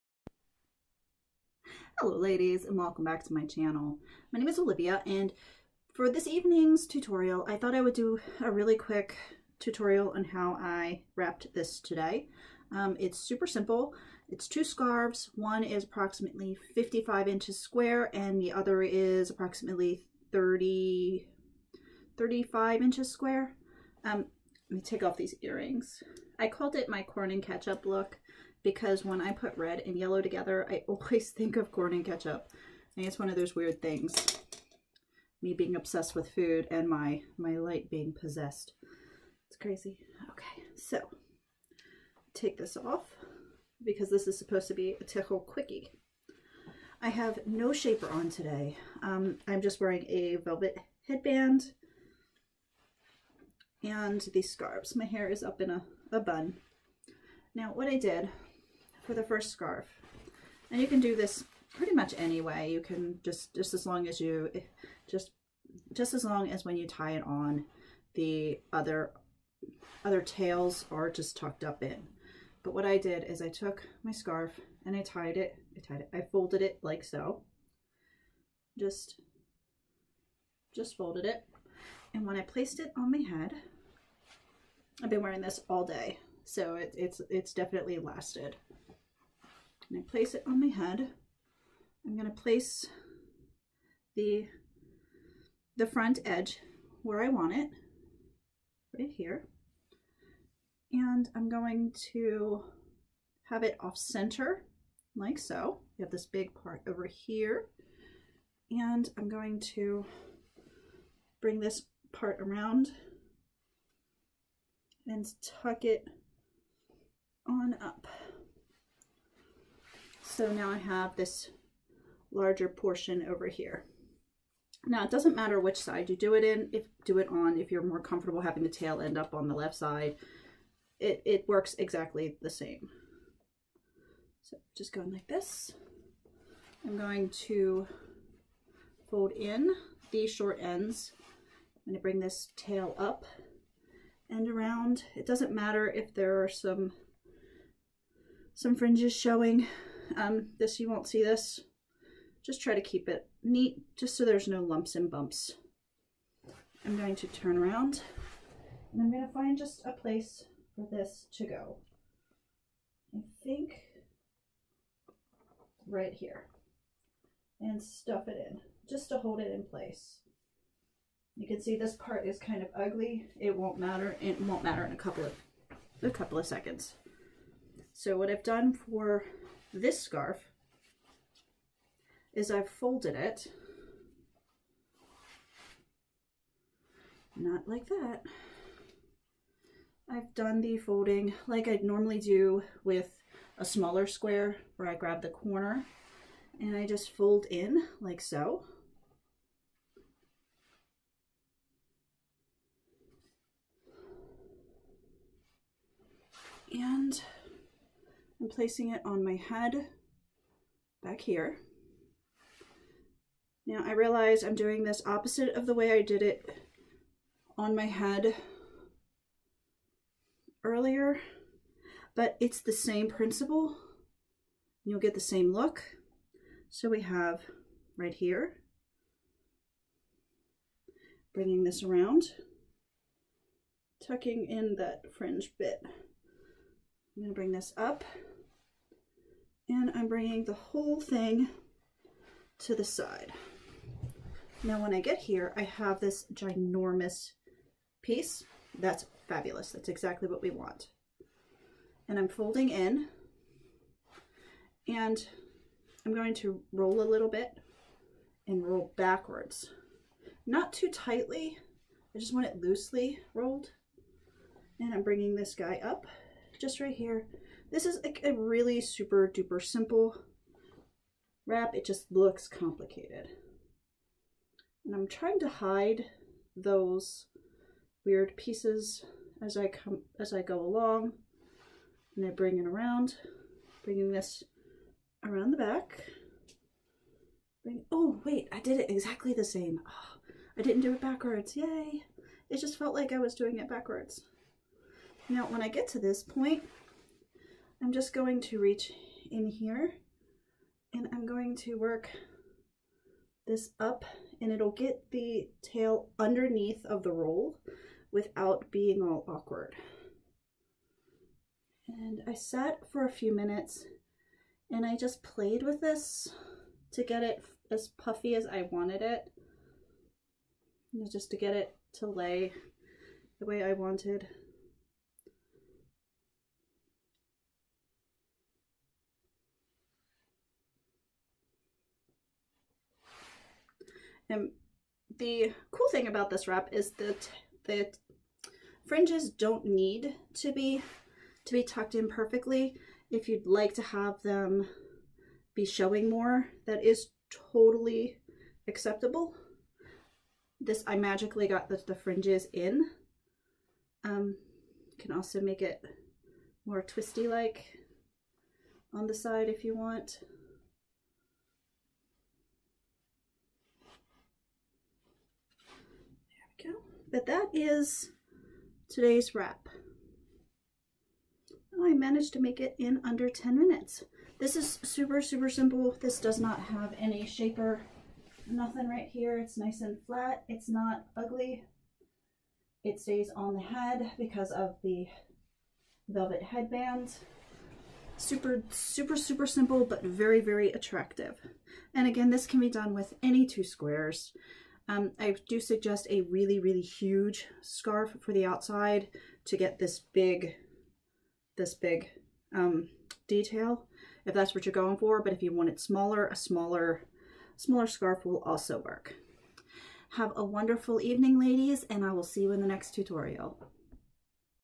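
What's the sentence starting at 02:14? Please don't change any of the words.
So just going like this, I'm going to fold in these short ends.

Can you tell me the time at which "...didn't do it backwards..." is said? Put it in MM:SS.
04:50.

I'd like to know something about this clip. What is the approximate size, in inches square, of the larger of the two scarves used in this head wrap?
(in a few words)
55 inches.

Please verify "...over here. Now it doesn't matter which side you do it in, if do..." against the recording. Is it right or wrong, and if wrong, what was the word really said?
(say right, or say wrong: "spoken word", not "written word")
right.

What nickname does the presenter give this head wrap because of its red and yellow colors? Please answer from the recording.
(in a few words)
corn and ketchup look.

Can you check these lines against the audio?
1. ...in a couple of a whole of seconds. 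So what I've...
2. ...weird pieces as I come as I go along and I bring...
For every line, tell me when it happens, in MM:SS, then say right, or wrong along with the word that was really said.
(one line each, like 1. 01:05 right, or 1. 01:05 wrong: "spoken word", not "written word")
1. 02:54 wrong: "couple", not "whole"
2. 04:38 right.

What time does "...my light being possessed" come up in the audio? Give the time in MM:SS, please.
00:37.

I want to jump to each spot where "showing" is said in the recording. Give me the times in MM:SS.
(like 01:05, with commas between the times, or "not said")
02:29, 05:45.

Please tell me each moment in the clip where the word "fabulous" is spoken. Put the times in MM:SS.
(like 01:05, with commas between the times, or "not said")
04:09.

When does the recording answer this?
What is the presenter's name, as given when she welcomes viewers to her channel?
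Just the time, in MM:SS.
00:04.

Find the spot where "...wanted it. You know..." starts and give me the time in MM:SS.
05:18.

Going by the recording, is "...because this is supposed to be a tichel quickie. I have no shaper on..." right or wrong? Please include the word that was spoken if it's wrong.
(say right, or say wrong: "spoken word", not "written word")
right.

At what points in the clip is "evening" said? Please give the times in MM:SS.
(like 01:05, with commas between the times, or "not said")
00:06, 06:50.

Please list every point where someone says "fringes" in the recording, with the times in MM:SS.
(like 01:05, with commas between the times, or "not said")
02:28, 03:55, 05:38, 05:51.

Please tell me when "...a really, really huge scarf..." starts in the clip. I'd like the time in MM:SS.
06:36.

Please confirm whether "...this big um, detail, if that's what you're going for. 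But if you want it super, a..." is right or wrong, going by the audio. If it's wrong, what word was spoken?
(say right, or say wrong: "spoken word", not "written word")
wrong: "smaller", not "super".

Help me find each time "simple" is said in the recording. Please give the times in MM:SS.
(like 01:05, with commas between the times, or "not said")
00:13, 04:29, 06:15, 06:29.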